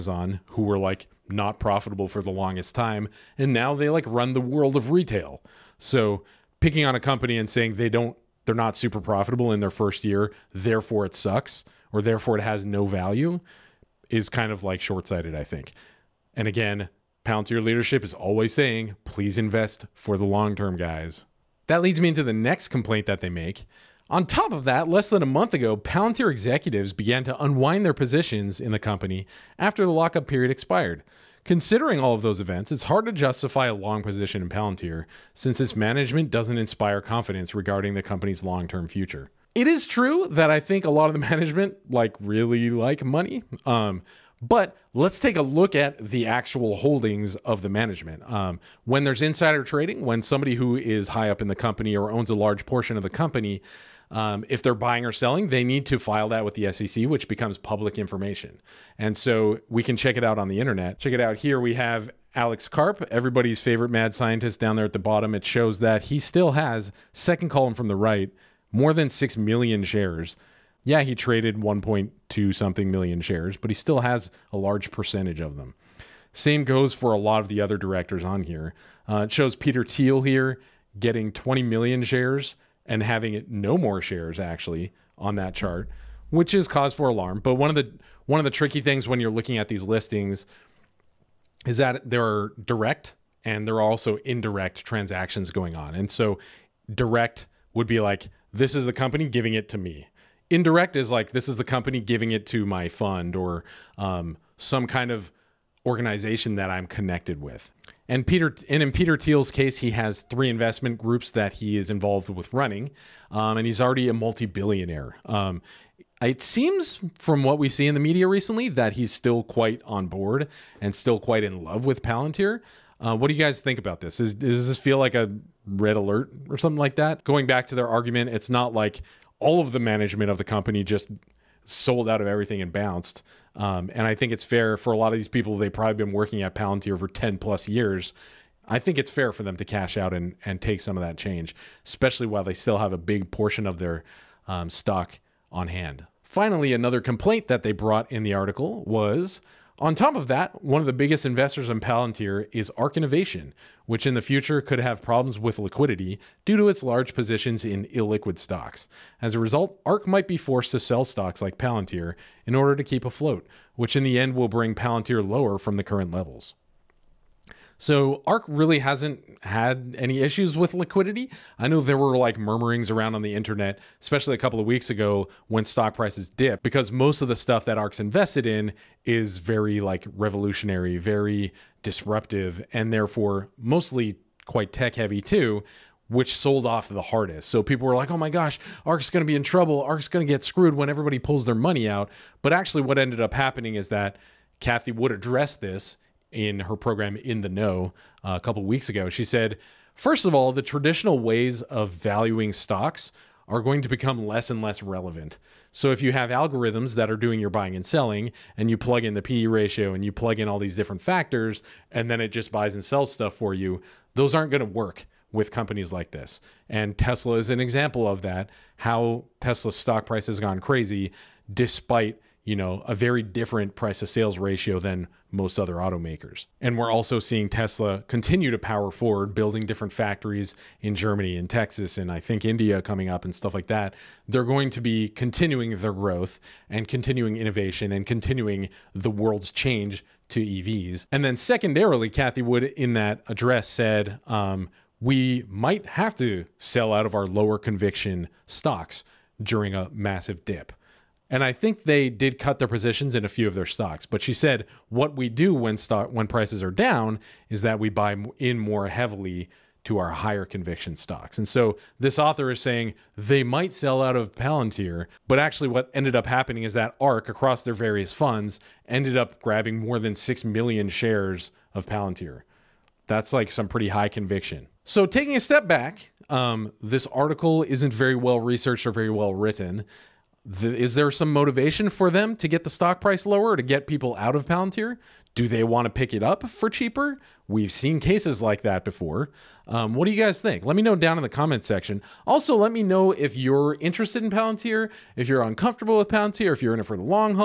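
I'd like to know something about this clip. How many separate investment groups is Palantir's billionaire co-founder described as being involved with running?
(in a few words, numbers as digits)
3.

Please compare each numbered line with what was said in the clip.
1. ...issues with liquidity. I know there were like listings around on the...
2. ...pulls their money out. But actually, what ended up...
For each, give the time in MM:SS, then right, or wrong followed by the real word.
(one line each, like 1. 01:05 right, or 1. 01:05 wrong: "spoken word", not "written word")
1. 02:50 wrong: "murmurings", not "listings"
2. 03:11 right.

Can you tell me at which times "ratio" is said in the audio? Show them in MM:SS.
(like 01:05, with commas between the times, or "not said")
03:29, 03:44.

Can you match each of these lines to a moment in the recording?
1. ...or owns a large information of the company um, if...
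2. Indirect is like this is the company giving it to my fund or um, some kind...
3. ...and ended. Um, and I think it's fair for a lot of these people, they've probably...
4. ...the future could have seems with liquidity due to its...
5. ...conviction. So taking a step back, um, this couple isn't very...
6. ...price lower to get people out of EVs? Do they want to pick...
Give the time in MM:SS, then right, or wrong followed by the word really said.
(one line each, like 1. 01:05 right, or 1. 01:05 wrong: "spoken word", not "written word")
1. 00:51 wrong: "portion", not "information"
2. 01:40 right
3. 02:12 wrong: "bounced", not "ended"
4. 02:34 wrong: "problems", not "seems"
5. 04:34 wrong: "article", not "couple"
6. 04:42 wrong: "Palantir", not "EVs".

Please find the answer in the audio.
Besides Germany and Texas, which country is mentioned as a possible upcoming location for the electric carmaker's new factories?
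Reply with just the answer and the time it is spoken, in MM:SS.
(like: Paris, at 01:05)
India, at 03:52.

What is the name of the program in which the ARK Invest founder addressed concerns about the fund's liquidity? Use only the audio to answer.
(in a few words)
In the Know.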